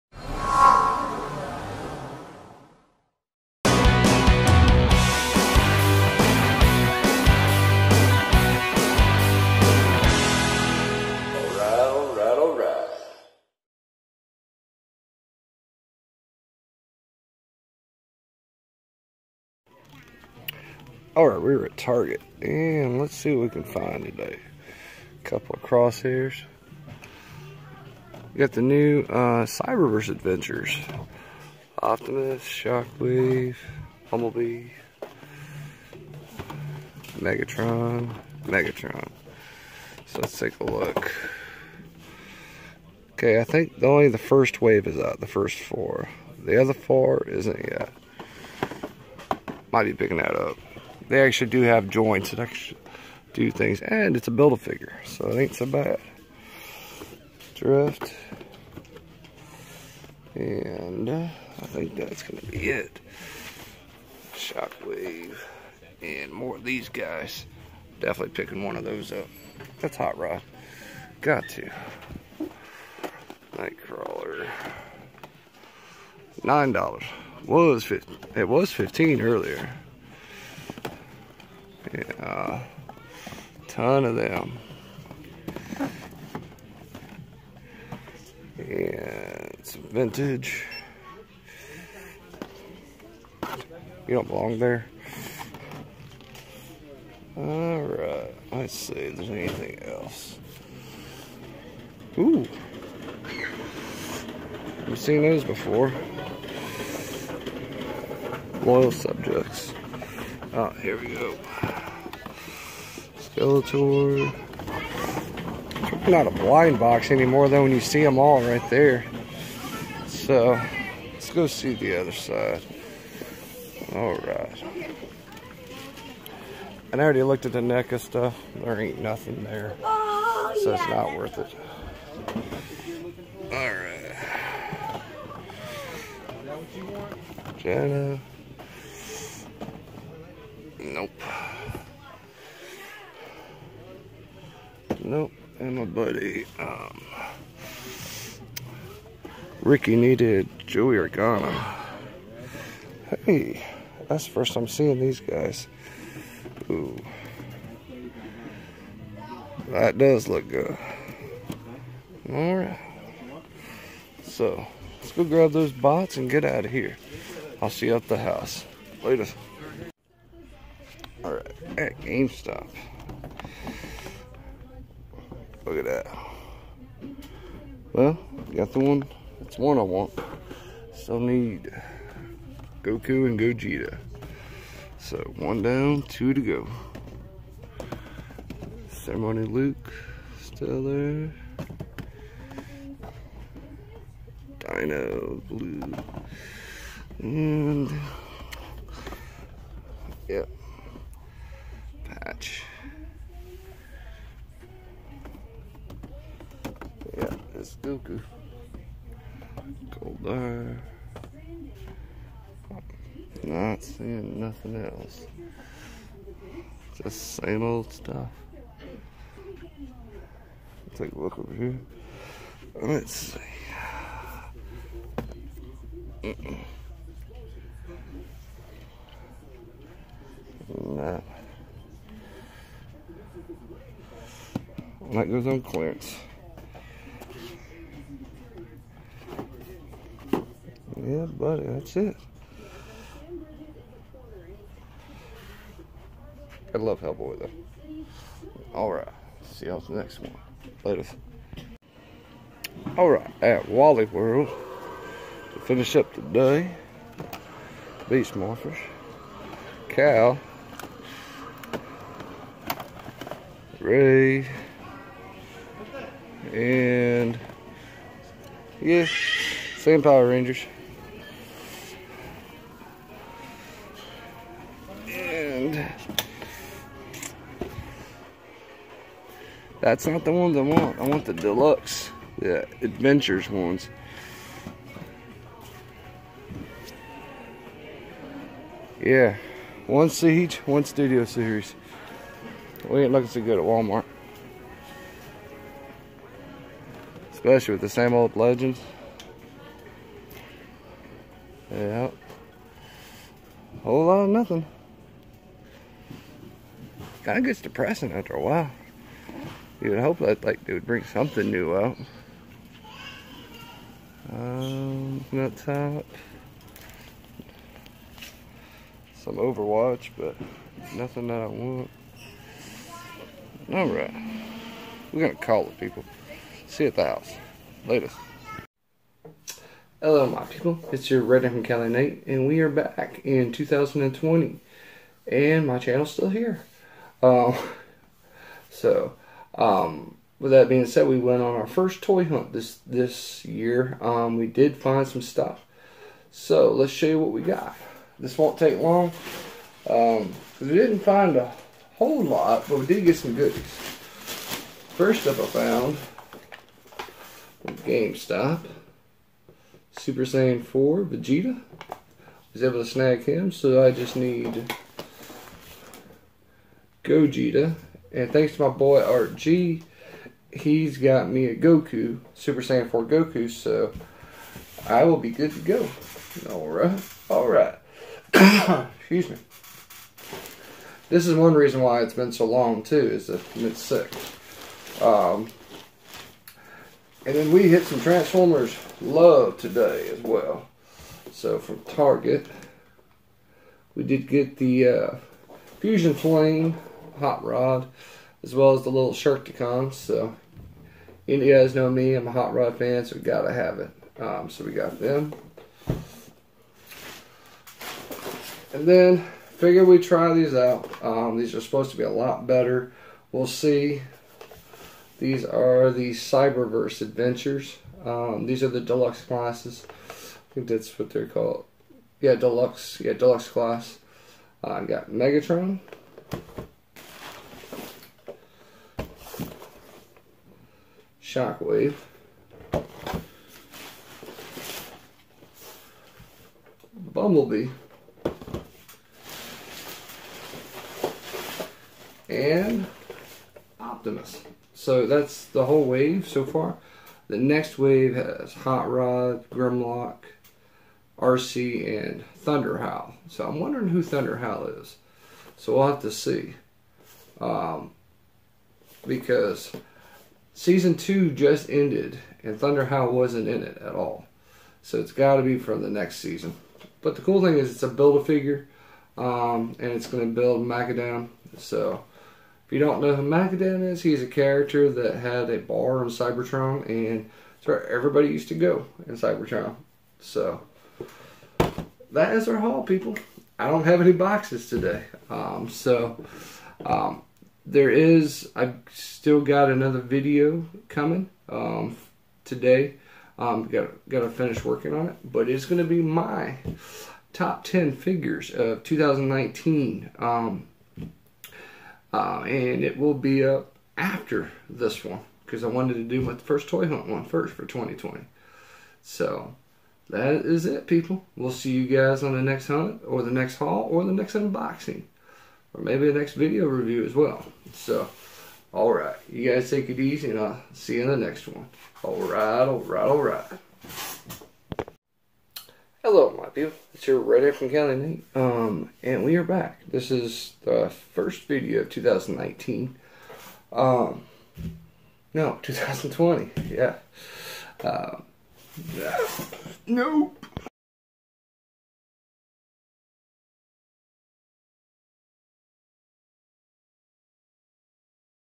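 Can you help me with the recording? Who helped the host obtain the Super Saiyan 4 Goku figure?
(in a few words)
Art G.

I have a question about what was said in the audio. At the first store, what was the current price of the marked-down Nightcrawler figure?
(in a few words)
$9.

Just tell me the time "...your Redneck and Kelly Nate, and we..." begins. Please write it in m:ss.
5:31.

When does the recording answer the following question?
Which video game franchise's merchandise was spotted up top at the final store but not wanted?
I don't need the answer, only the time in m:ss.
5:19.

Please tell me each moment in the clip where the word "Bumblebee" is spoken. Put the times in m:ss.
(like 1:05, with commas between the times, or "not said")
0:34, 7:17.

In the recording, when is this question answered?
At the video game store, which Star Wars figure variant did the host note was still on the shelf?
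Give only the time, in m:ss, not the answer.
3:08.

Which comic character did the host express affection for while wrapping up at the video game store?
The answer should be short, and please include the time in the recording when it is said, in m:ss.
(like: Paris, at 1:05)
Hellboy, at 4:07.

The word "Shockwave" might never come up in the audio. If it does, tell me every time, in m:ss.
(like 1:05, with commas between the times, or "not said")
0:32, 1:04, 7:11.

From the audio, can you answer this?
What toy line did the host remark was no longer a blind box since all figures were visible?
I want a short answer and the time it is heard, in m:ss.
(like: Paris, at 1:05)
Loyal subjects, at 1:48.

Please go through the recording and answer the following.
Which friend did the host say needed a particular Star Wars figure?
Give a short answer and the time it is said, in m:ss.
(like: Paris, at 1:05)
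Ricky, at 2:29.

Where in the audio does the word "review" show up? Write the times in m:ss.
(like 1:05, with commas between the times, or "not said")
8:36.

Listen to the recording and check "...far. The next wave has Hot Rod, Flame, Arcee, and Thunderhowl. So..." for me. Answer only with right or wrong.
wrong.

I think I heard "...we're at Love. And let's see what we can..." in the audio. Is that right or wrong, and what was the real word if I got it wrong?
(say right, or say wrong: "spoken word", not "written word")
wrong: "Target", not "Love".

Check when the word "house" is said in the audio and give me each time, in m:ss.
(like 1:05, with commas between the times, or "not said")
2:48, 5:27.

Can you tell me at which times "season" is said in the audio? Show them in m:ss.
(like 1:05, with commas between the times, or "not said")
7:40, 7:46.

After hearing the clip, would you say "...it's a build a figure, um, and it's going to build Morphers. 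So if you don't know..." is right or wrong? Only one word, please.
wrong.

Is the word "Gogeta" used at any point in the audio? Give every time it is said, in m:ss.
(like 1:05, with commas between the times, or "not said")
3:03, 6:07.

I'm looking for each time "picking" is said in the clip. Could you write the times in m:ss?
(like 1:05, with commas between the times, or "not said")
0:49, 1:08.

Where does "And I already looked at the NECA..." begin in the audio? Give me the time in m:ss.
2:06.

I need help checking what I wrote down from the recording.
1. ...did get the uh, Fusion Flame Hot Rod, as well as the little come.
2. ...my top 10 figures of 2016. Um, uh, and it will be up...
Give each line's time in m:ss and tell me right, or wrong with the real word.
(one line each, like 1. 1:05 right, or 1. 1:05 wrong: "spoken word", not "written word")
1. 6:34 right
2. 8:16 wrong: "2019", not "2016".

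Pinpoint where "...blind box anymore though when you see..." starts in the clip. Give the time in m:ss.
1:56.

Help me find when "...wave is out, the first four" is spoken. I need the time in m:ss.
0:44.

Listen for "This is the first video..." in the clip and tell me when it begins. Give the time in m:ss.
8:49.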